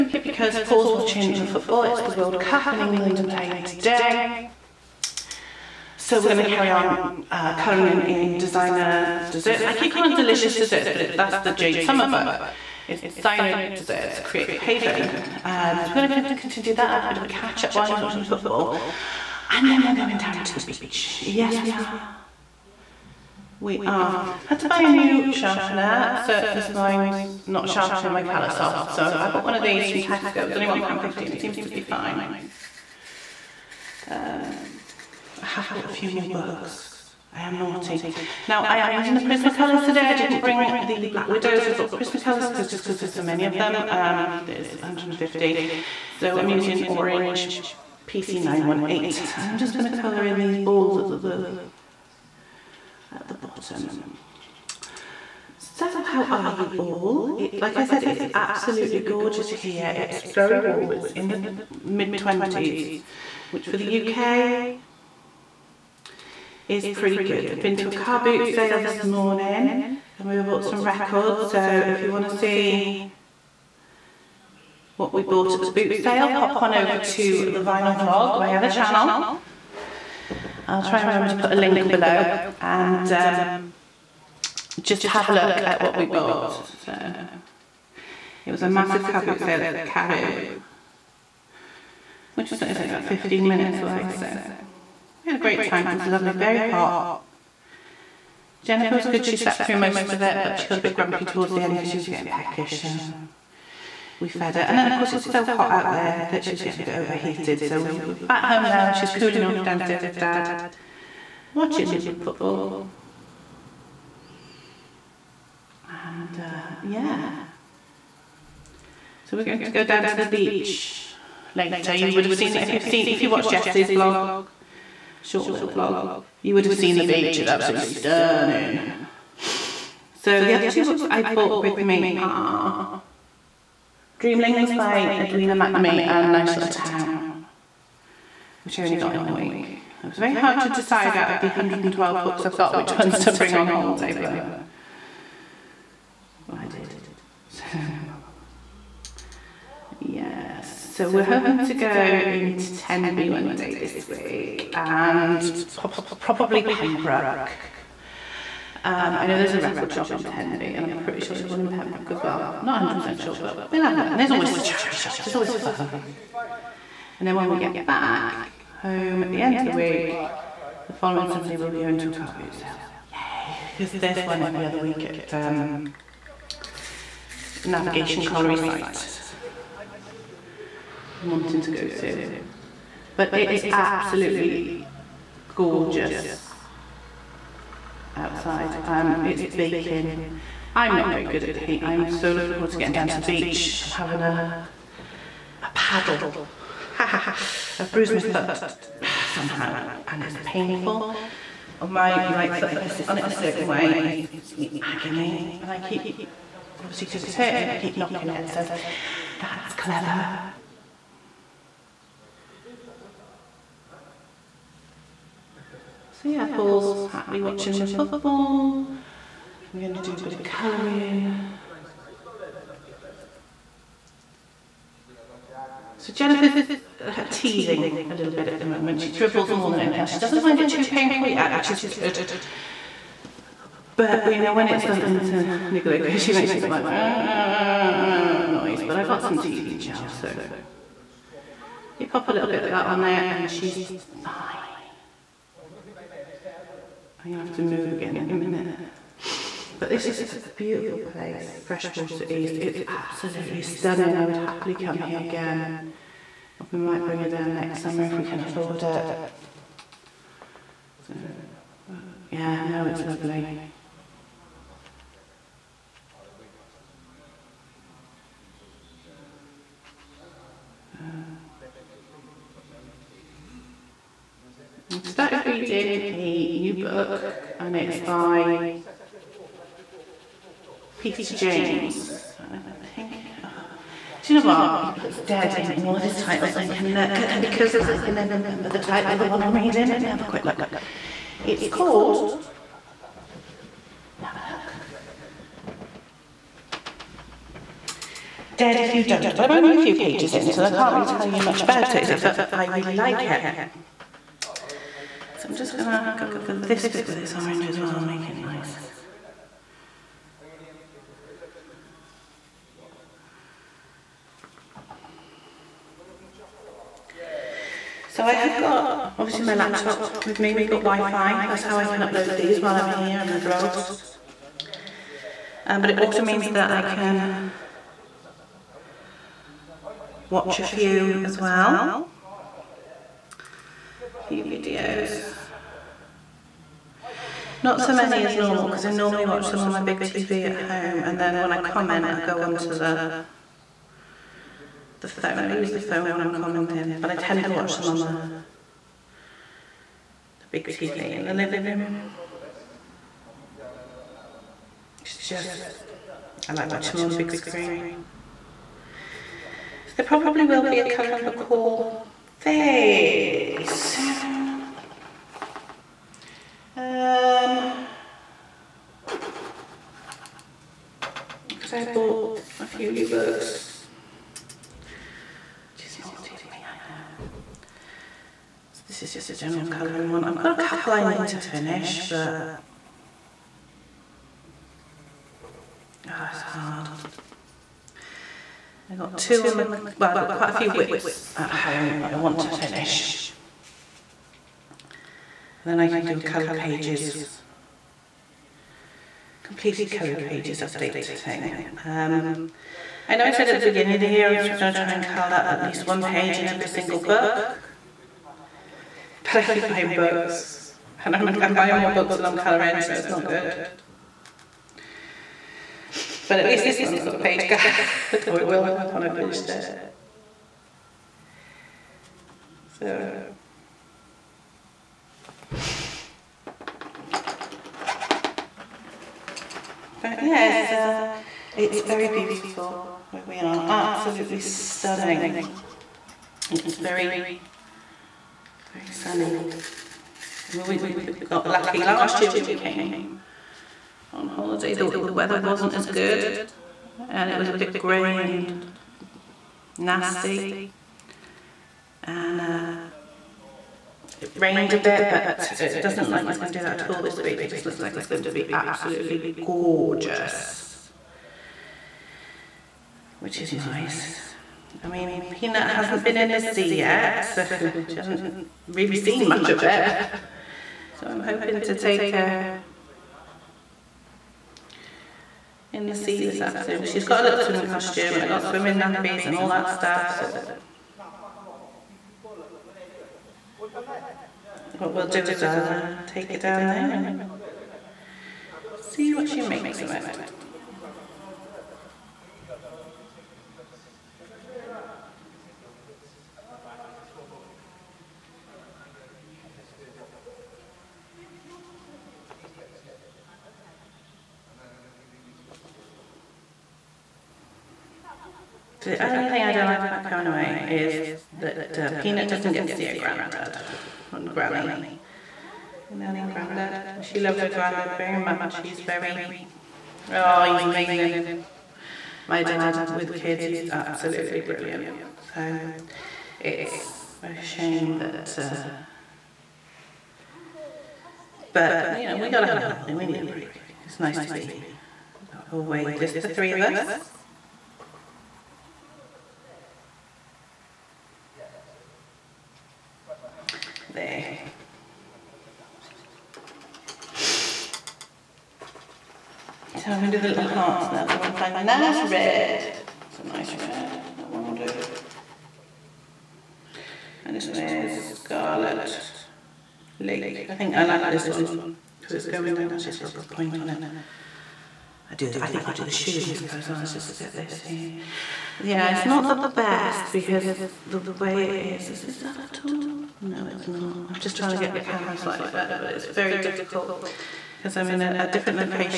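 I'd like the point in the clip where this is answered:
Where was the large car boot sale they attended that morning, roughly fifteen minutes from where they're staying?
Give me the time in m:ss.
1:29.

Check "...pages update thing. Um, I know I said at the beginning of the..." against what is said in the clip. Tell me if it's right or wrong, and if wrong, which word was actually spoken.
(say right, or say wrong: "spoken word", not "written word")
right.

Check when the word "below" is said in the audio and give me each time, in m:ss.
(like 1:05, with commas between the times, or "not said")
1:21.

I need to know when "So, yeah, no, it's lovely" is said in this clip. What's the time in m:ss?
4:21.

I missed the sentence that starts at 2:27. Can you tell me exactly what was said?
So Yes, so we're hoping to go into Tenby one day this week and probably Pembroke.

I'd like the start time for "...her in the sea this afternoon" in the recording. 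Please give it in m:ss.
7:52.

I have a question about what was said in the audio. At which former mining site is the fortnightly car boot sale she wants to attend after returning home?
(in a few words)
Navigation Colliery.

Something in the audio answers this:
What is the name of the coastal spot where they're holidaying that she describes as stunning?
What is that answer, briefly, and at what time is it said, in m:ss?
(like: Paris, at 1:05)
Freshwater East, at 4:11.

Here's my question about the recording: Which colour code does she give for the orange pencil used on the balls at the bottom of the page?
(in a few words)
PC918.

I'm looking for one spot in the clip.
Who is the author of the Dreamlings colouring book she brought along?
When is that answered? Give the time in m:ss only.
2:15.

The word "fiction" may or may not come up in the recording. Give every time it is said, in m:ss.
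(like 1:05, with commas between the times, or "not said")
not said.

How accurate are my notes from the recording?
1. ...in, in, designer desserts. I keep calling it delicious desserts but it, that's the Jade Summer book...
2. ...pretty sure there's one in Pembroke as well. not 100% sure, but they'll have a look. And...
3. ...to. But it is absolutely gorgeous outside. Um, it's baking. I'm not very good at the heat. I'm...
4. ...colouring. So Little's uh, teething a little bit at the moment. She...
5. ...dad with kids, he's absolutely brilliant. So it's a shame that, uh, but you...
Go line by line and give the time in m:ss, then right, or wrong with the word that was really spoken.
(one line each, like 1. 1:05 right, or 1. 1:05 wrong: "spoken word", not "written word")
1. 0:07 right
2. 2:40 right
3. 3:01 right
4. 3:40 wrong: "Jennifer", not "Little"
5. 8:42 right.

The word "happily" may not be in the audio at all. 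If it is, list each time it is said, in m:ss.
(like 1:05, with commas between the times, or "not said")
3:37, 4:14.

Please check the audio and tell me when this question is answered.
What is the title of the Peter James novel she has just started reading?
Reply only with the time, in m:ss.
4:58.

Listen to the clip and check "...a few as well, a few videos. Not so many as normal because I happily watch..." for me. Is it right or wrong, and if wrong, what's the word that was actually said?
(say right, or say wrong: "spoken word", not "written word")
wrong: "normally", not "happily".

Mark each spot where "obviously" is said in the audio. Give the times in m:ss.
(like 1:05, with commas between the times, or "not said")
3:26, 5:19.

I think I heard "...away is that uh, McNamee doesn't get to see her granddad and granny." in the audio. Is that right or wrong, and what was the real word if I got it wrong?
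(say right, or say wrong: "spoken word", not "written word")
wrong: "Peanut", not "McNamee".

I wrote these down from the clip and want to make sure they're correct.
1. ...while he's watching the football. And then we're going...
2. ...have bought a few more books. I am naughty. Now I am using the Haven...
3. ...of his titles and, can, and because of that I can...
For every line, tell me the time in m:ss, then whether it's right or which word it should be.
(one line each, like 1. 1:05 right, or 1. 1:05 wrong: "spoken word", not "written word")
1. 0:17 right
2. 0:35 wrong: "Prismacolors", not "Haven"
3. 4:45 right.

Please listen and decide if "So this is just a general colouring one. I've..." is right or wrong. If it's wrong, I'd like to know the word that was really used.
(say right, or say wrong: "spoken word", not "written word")
right.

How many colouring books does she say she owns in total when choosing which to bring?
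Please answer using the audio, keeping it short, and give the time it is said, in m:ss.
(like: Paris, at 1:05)
112, at 2:21.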